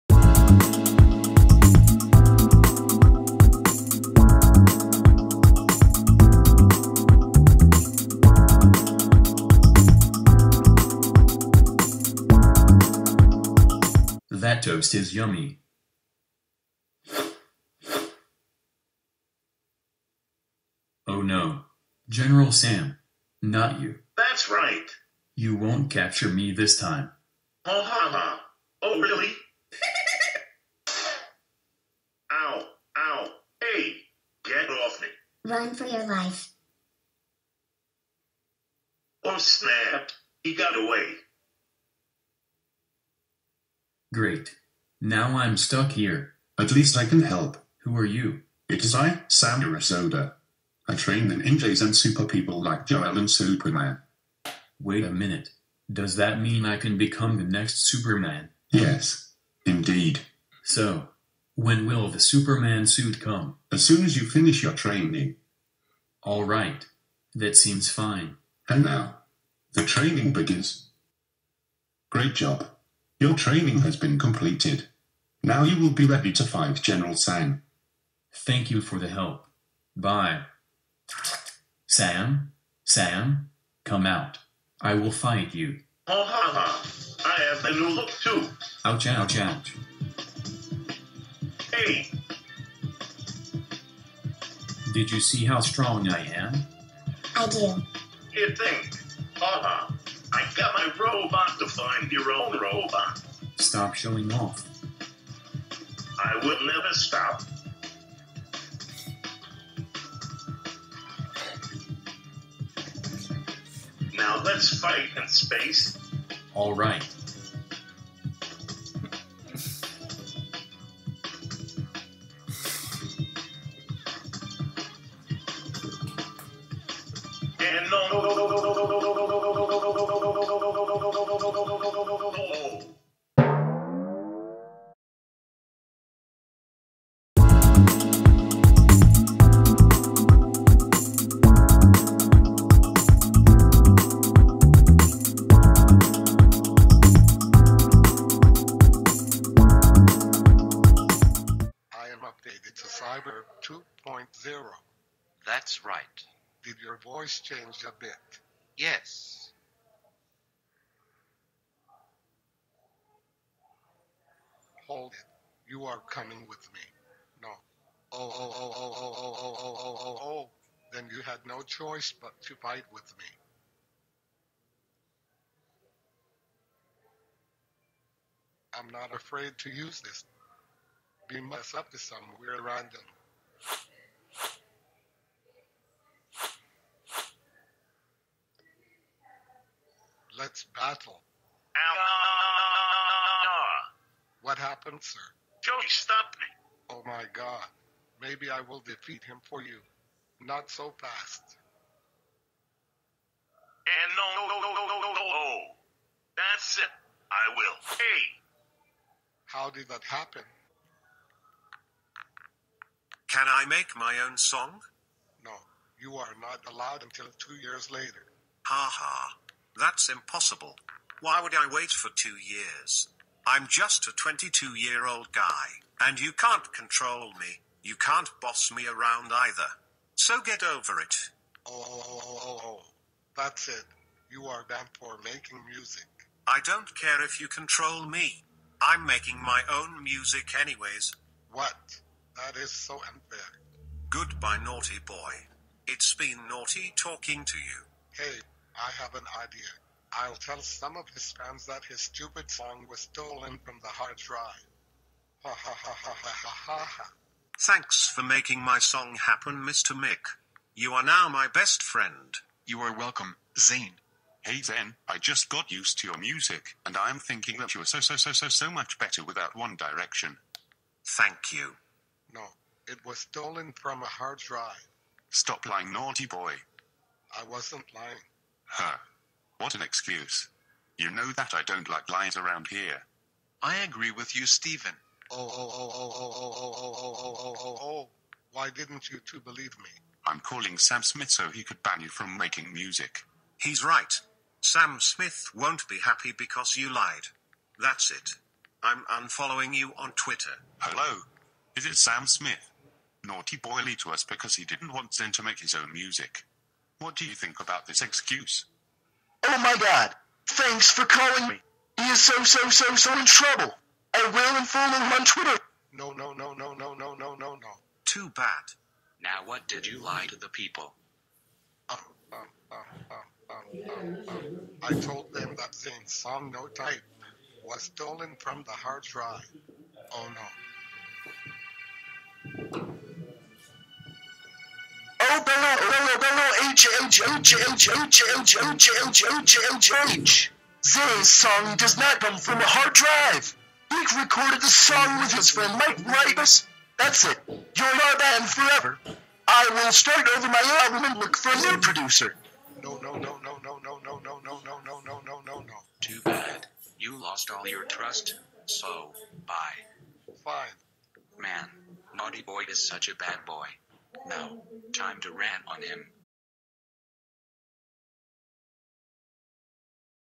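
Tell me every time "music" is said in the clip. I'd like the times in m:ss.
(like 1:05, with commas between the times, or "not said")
3:55, 4:00, 4:26, 4:52, 5:05.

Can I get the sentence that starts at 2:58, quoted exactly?
I'm not afraid to use this being messed up is somewhere random.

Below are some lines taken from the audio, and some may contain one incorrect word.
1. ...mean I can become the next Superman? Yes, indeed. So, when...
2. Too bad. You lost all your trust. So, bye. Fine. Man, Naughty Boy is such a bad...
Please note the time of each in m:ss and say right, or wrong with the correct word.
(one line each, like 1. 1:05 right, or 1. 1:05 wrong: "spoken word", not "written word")
1. 0:56 right
2. 5:55 right.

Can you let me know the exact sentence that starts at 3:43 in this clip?
I'm just a 22 year old guy, and you can't control me.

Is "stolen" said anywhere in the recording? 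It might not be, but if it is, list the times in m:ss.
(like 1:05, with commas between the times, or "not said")
4:13, 4:33, 5:27.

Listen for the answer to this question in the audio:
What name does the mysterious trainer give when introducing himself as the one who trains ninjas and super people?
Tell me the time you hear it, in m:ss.
0:49.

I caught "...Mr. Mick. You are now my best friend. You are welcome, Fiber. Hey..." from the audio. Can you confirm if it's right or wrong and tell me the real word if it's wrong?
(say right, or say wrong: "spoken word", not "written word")
wrong: "Zayn", not "Fiber".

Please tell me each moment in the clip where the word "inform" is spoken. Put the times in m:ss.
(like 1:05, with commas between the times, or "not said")
5:14.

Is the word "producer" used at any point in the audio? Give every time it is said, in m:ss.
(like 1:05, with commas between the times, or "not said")
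5:51.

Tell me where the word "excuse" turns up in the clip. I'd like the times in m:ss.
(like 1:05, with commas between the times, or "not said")
4:39, 5:08.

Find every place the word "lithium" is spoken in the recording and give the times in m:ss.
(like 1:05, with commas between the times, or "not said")
not said.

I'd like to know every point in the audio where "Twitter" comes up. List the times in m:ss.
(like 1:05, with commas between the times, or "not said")
5:00, 5:15.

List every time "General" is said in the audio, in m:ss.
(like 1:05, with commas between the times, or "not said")
0:22, 1:16.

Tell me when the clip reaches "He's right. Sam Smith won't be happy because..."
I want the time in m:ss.
4:53.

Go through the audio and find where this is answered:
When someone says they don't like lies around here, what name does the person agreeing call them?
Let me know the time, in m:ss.
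4:44.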